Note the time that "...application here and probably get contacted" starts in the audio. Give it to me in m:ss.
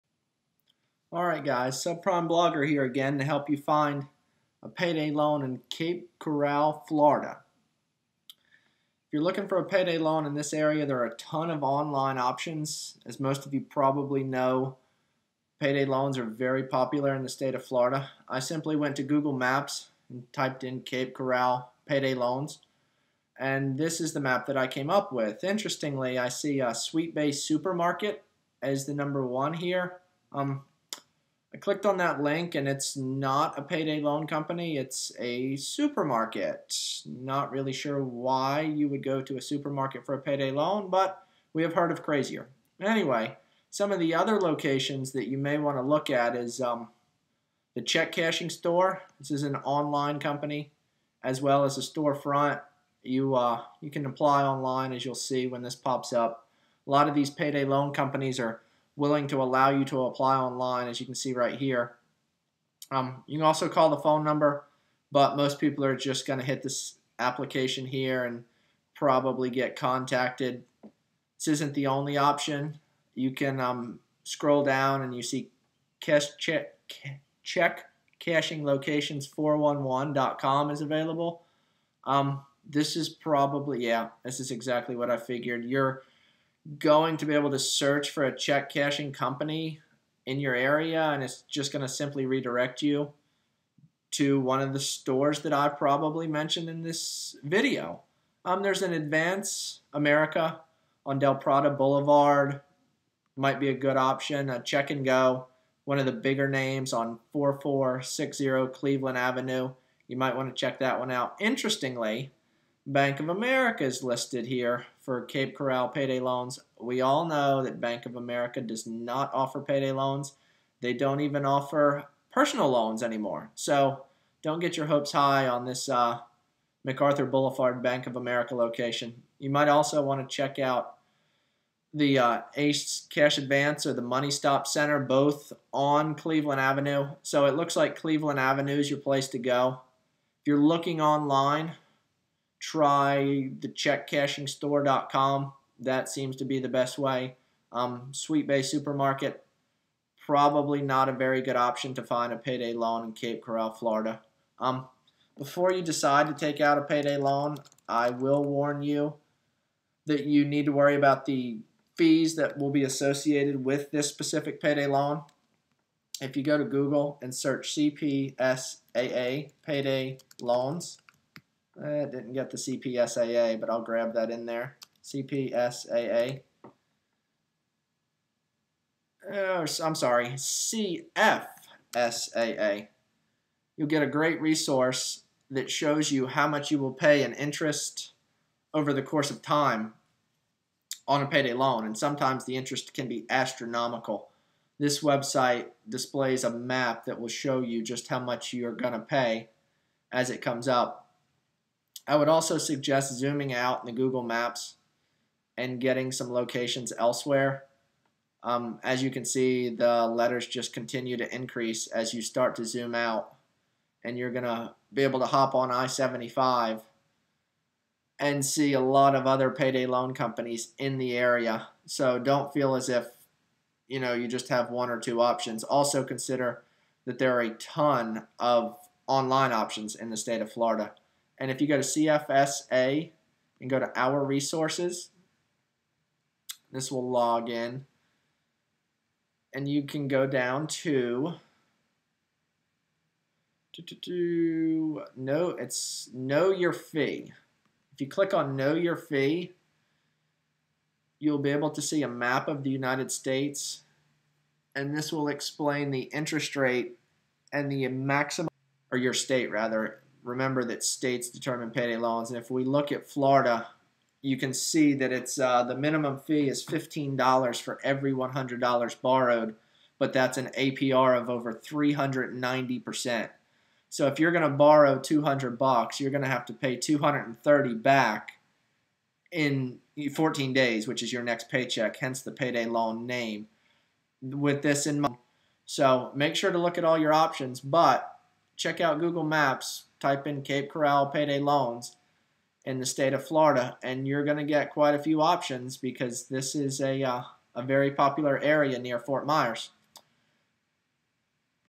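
1:07.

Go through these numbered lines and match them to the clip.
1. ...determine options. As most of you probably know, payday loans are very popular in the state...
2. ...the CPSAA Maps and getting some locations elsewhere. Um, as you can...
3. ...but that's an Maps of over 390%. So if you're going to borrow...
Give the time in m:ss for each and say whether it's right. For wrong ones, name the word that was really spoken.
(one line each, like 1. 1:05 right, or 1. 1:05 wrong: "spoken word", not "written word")
1. 0:11 wrong: "online", not "determine"
2. 3:23 wrong: "Google", not "CPSAA"
3. 4:29 wrong: "APR", not "Maps".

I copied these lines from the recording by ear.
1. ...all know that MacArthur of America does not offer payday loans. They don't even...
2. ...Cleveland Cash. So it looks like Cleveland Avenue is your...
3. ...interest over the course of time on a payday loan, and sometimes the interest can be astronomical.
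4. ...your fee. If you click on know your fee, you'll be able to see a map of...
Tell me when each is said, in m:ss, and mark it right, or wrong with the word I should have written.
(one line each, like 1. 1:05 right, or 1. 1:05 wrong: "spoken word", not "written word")
1. 1:57 wrong: "Bank", not "MacArthur"
2. 2:16 wrong: "Avenue", not "Cash"
3. 3:07 right
4. 4:06 right.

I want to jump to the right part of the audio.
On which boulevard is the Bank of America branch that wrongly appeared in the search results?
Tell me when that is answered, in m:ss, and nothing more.
2:06.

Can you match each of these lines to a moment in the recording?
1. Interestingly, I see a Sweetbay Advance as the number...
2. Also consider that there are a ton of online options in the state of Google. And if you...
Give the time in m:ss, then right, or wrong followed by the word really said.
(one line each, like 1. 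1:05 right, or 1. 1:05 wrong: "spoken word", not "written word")
1. 0:25 wrong: "Supermarket", not "Advance"
2. 3:45 wrong: "Florida", not "Google".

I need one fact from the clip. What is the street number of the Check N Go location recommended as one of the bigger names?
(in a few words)
4460.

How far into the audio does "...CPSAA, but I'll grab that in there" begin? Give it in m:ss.
2:52.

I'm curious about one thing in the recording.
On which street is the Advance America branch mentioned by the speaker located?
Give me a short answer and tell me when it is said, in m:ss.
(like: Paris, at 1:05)
Del Prado Boulevard, at 1:41.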